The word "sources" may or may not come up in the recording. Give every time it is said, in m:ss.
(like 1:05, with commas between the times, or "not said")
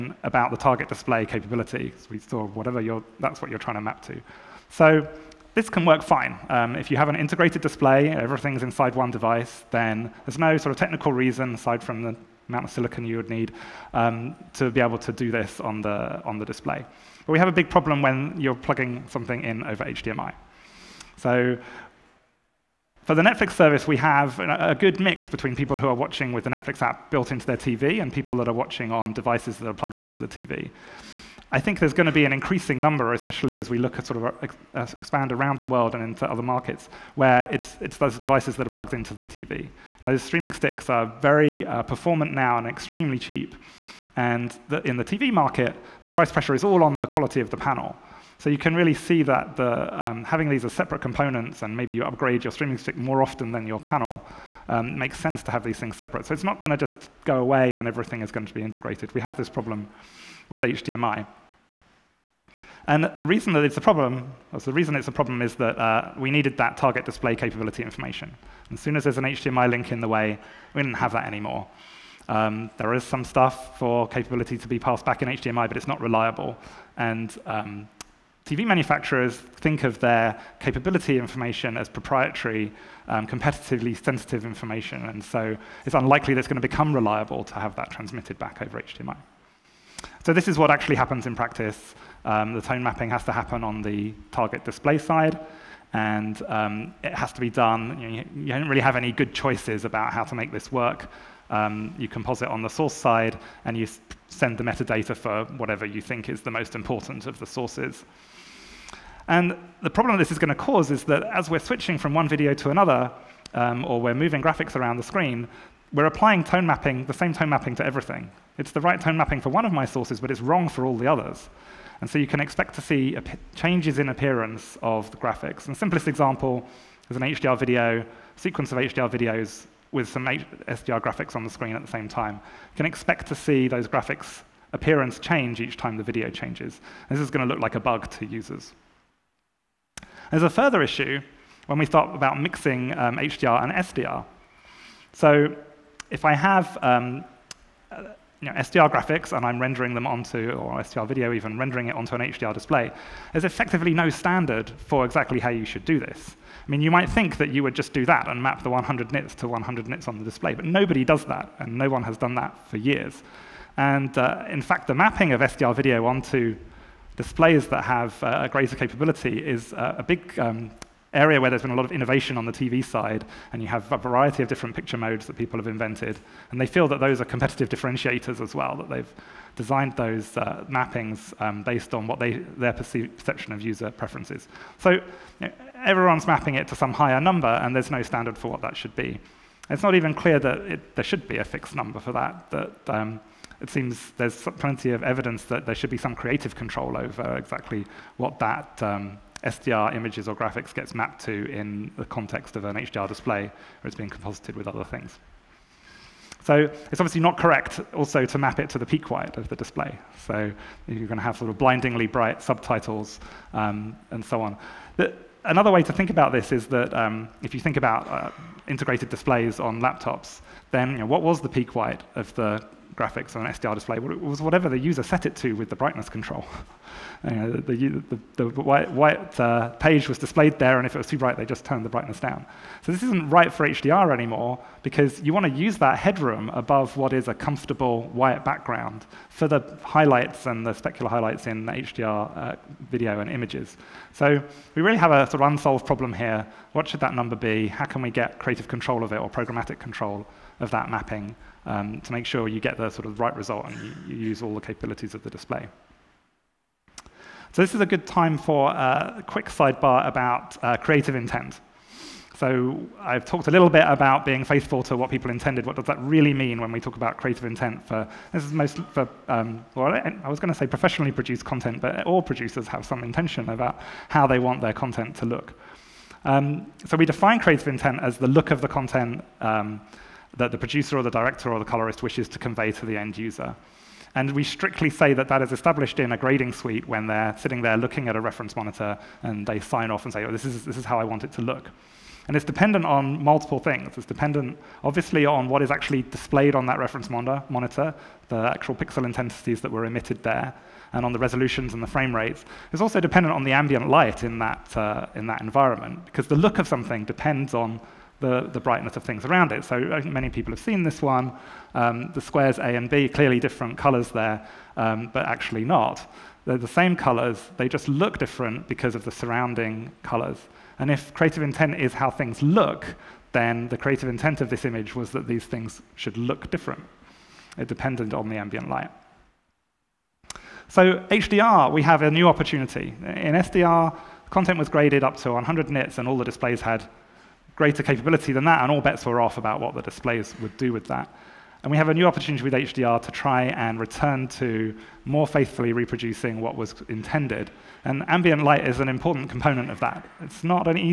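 1:42, 1:47, 1:59.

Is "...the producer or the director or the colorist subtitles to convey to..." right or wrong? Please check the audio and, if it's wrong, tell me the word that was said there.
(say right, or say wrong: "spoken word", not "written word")
wrong: "wishes", not "subtitles".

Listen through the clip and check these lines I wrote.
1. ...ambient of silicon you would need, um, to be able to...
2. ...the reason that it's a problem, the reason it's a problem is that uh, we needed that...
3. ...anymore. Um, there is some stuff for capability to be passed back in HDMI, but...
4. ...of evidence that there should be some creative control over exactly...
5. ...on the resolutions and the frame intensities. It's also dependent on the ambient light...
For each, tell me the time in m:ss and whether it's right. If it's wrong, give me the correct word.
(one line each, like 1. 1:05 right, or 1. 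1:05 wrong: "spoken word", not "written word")
1. 0:12 wrong: "amount", not "ambient"
2. 1:03 right
3. 1:11 right
4. 3:14 right
5. 5:01 wrong: "rates", not "intensities".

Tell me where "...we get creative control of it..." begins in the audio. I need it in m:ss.
4:08.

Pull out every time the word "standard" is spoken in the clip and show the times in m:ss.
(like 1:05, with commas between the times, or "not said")
2:34, 3:08.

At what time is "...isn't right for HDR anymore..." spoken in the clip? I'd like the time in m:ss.
3:53.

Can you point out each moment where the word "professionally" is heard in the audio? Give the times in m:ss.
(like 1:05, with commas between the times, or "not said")
4:30.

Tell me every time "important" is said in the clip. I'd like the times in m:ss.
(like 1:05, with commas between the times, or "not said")
1:46, 5:48.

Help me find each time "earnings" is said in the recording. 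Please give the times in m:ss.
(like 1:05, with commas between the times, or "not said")
not said.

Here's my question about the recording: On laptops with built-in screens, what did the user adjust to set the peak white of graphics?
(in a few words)
brightness control.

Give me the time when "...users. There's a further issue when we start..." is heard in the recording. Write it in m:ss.
2:18.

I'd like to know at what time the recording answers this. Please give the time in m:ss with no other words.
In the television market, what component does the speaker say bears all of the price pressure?
0:46.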